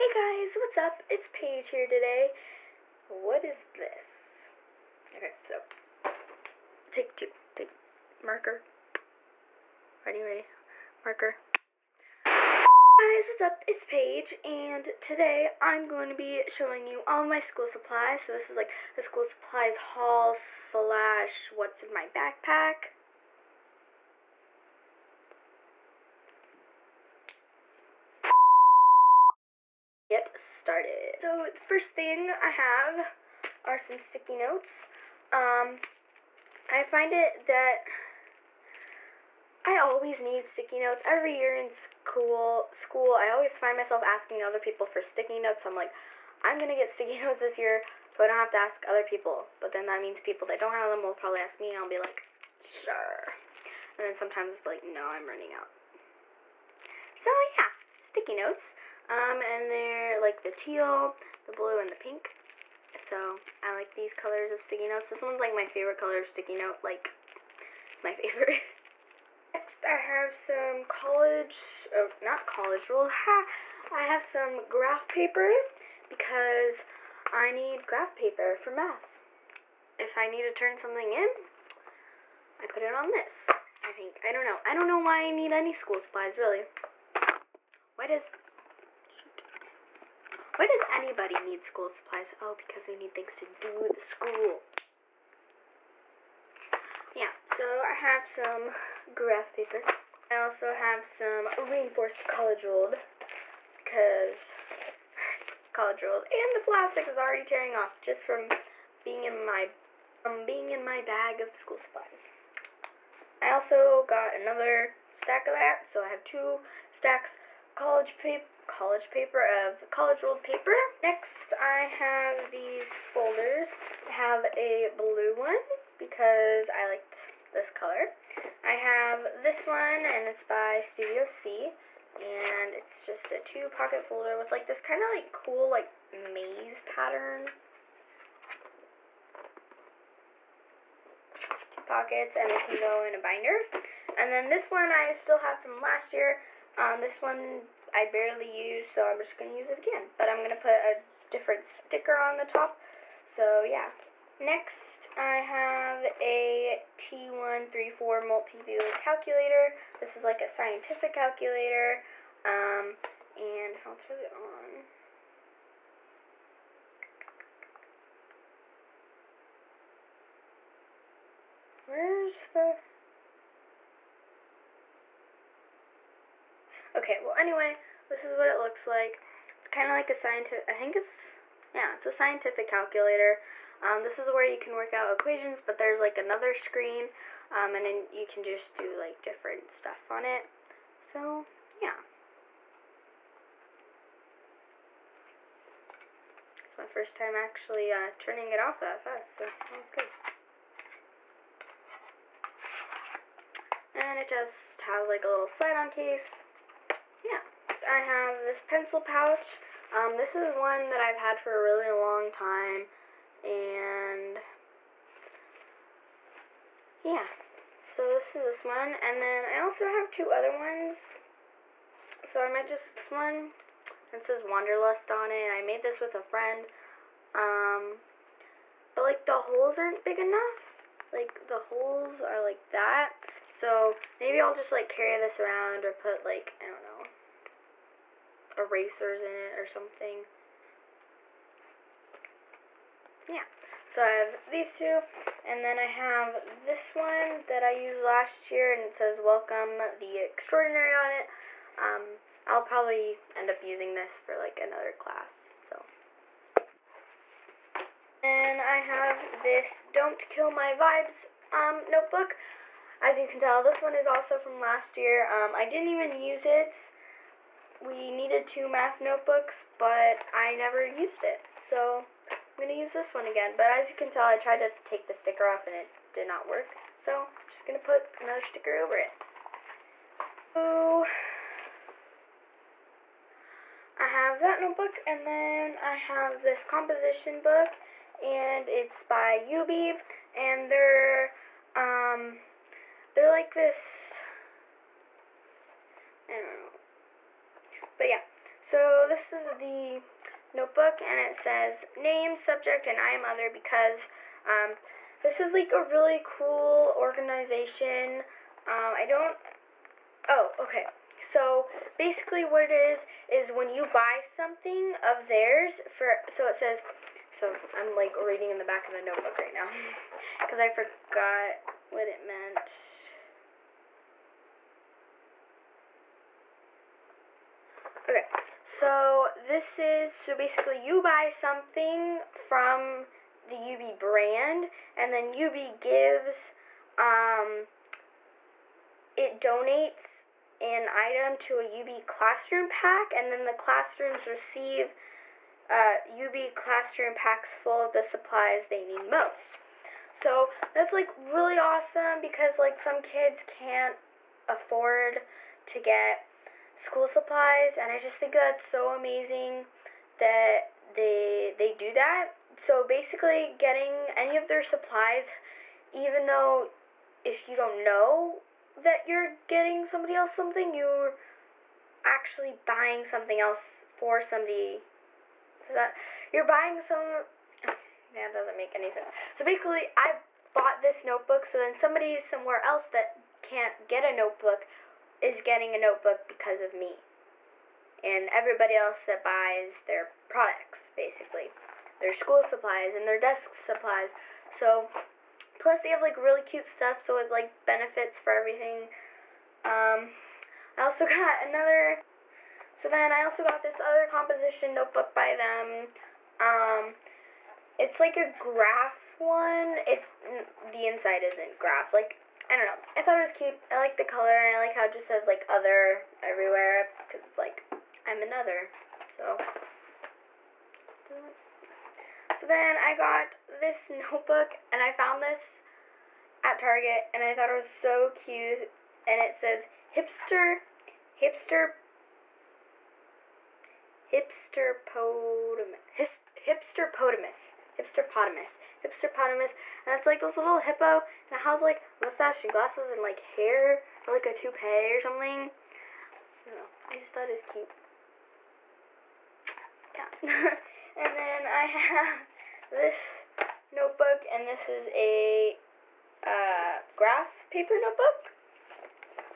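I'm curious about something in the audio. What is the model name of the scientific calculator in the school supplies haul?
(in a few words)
TI-34 multi-view.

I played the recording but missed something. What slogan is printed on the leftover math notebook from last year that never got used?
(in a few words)
Don't Kill My Vibes.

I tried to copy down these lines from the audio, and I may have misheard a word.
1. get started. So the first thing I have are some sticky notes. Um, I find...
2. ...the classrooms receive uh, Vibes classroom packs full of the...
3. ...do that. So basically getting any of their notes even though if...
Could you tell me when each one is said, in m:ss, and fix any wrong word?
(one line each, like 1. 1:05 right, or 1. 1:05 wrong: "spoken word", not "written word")
1. 0:30 right
2. 5:43 wrong: "Yoobi", not "Vibes"
3. 6:01 wrong: "supplies", not "notes".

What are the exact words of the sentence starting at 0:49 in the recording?
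But then that means people that don't have them will probably ask me, and I'll be like, sure.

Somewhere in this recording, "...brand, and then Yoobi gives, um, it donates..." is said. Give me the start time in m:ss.
5:33.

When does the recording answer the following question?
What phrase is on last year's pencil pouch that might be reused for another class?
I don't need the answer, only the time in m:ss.
4:09.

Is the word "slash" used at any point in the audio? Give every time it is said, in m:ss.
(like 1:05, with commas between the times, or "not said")
0:20.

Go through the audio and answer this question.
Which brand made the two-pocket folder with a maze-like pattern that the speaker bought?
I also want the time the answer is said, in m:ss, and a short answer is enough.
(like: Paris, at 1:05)
Studio C, at 2:10.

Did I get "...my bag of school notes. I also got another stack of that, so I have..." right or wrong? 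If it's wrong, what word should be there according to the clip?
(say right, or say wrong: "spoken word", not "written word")
wrong: "supplies", not "notes".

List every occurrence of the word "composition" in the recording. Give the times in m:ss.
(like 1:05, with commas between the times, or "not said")
4:46, 6:44.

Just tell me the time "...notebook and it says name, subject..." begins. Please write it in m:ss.
5:00.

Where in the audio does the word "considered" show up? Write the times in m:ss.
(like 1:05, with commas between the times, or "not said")
not said.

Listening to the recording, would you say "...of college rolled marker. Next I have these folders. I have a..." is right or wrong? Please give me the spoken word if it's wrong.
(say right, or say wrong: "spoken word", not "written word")
wrong: "paper", not "marker".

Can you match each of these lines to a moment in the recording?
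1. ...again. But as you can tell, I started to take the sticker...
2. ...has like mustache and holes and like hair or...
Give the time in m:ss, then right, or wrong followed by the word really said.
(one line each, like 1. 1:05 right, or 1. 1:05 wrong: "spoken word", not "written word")
1. 4:33 wrong: "tried", not "started"
2. 7:21 wrong: "glasses", not "holes".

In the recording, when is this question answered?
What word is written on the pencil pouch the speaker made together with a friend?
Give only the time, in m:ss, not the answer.
3:44.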